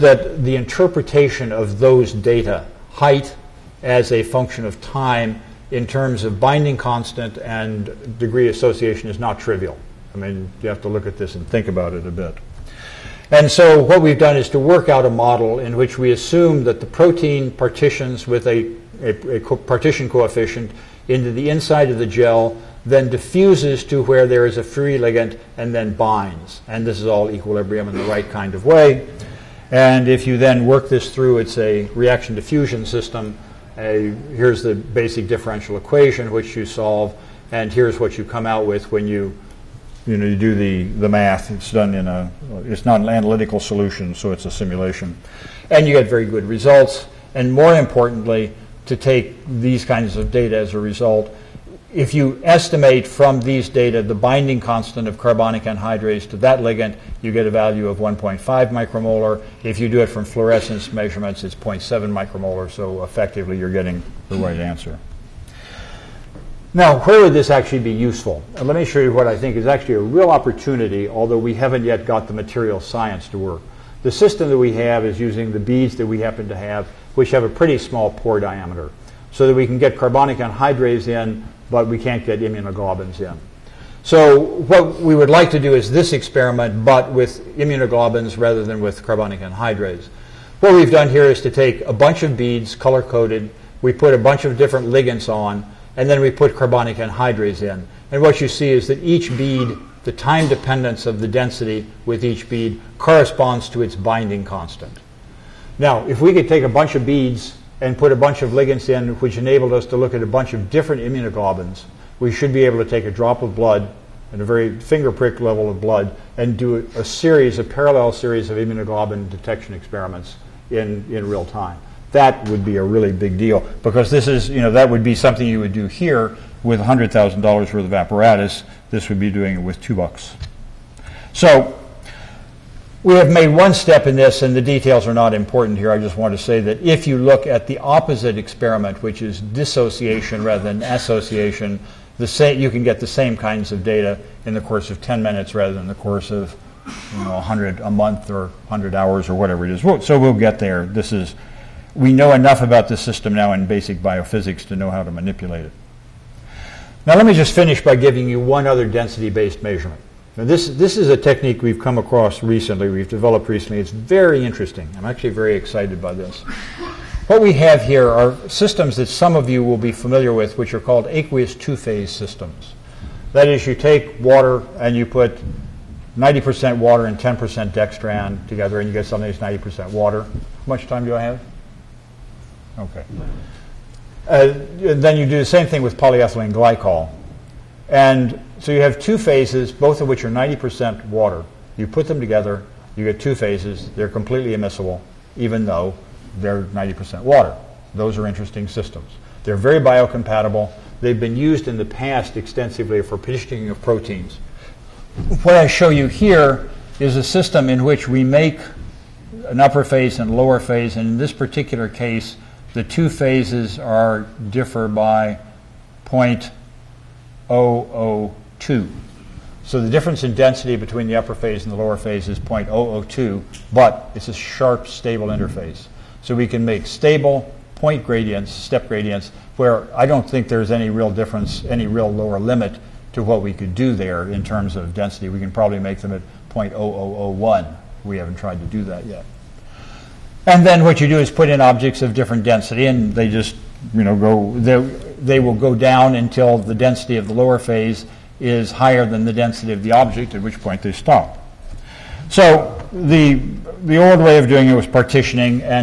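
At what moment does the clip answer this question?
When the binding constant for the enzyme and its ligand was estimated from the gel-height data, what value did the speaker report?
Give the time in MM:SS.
00:57.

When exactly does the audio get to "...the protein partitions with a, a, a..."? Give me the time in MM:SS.
00:16.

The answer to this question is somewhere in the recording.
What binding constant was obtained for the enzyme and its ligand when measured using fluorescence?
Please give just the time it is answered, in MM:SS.
01:01.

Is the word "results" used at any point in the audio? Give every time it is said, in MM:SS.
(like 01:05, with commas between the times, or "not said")
00:46, 00:50.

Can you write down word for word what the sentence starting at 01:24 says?
So what we would like to do is this experiment, but with immunoglobins rather than with carbonic anhydrase.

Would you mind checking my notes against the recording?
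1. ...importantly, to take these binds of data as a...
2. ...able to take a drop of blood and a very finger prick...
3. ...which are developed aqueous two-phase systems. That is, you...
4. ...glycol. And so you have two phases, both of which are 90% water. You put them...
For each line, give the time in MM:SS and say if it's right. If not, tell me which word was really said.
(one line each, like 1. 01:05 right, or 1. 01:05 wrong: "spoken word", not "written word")
1. 00:47 wrong: "kinds", not "binds"
2. 01:52 right
3. 02:50 wrong: "called", not "developed"
4. 03:06 right.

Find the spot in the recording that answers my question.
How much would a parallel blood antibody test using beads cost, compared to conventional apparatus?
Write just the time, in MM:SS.
02:09.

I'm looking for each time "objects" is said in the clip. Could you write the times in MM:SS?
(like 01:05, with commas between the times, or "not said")
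04:01, 04:09.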